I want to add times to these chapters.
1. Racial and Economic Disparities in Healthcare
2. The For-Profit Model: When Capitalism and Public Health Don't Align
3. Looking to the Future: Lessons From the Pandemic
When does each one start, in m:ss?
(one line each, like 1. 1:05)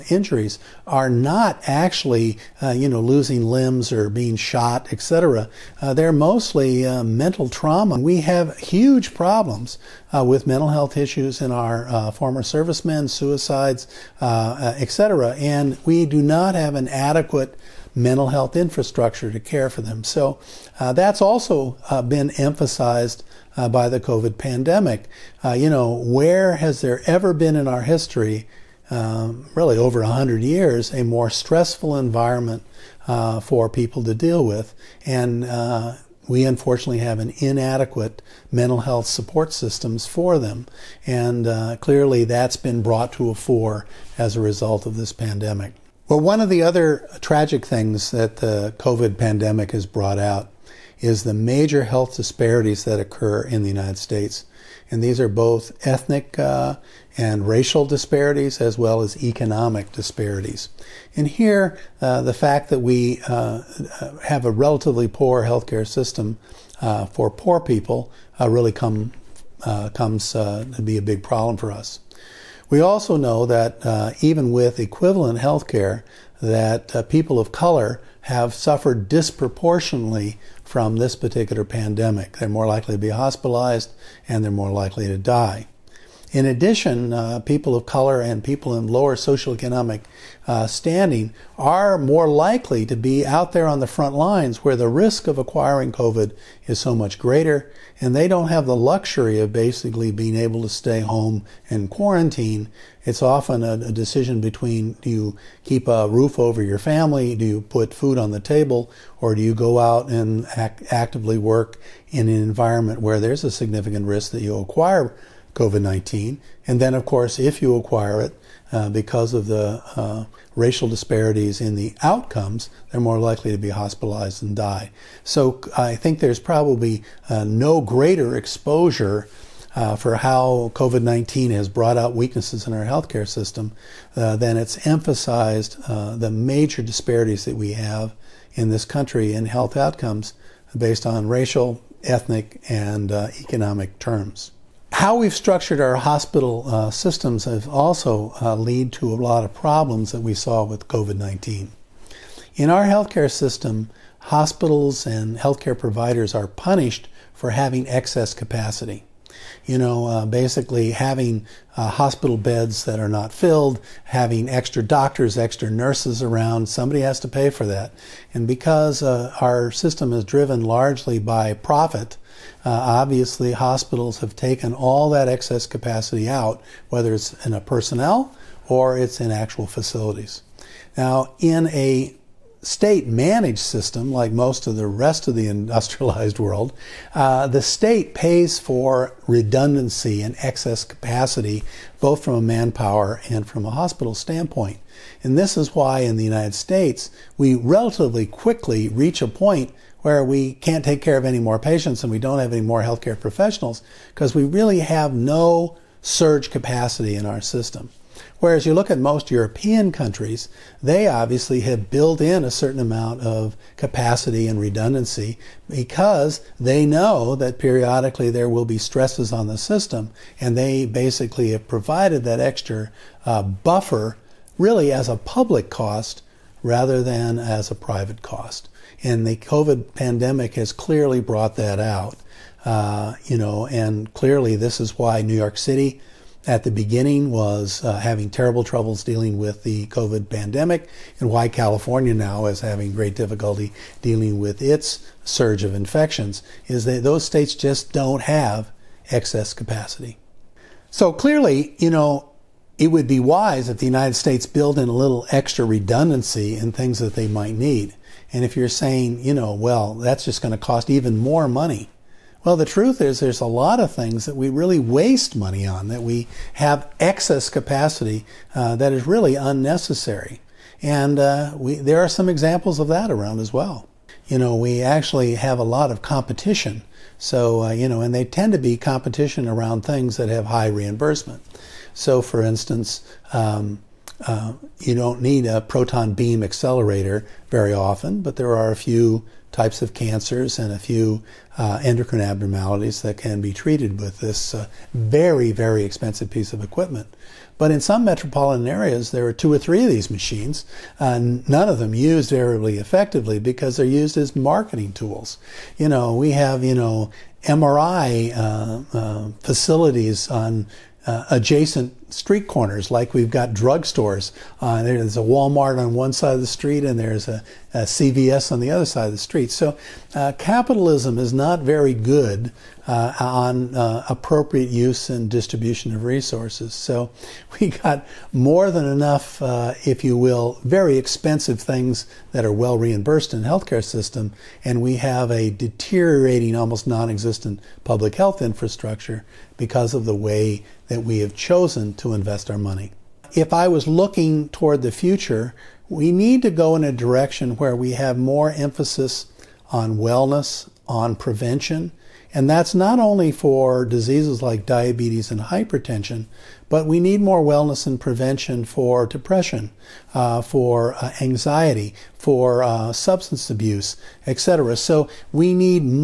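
1. 0:45
2. 2:24
3. 5:43.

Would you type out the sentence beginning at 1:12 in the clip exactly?
We also know that uh, even with equivalent health care, that uh, people of color have suffered disproportionately from this particular pandemic.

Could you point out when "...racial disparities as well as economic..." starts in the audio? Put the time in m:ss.
0:57.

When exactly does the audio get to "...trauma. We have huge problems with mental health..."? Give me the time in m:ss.
0:07.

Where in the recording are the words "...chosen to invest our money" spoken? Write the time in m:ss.
5:41.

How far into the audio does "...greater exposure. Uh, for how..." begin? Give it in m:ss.
2:07.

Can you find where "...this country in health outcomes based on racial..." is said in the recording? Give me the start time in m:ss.
2:18.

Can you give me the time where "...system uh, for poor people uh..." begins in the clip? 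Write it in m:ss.
1:05.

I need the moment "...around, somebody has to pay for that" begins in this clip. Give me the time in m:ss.
2:46.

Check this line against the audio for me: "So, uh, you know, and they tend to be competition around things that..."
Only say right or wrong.
right.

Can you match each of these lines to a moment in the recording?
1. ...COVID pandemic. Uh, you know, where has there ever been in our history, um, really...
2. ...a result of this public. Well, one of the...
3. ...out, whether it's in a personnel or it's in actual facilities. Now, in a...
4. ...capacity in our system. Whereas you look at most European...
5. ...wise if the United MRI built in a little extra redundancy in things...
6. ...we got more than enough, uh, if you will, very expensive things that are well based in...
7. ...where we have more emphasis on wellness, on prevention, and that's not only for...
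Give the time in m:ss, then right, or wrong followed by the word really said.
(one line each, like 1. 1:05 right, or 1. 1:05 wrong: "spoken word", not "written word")
1. 0:23 right
2. 0:44 wrong: "pandemic", not "public"
3. 2:56 right
4. 3:26 right
5. 4:13 wrong: "States", not "MRI"
6. 5:27 wrong: "reimbursed", not "based"
7. 5:47 right.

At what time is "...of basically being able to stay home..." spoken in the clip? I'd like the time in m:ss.
1:39.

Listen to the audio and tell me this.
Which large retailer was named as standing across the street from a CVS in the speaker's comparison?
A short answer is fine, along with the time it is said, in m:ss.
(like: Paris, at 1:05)
Walmart, at 5:15.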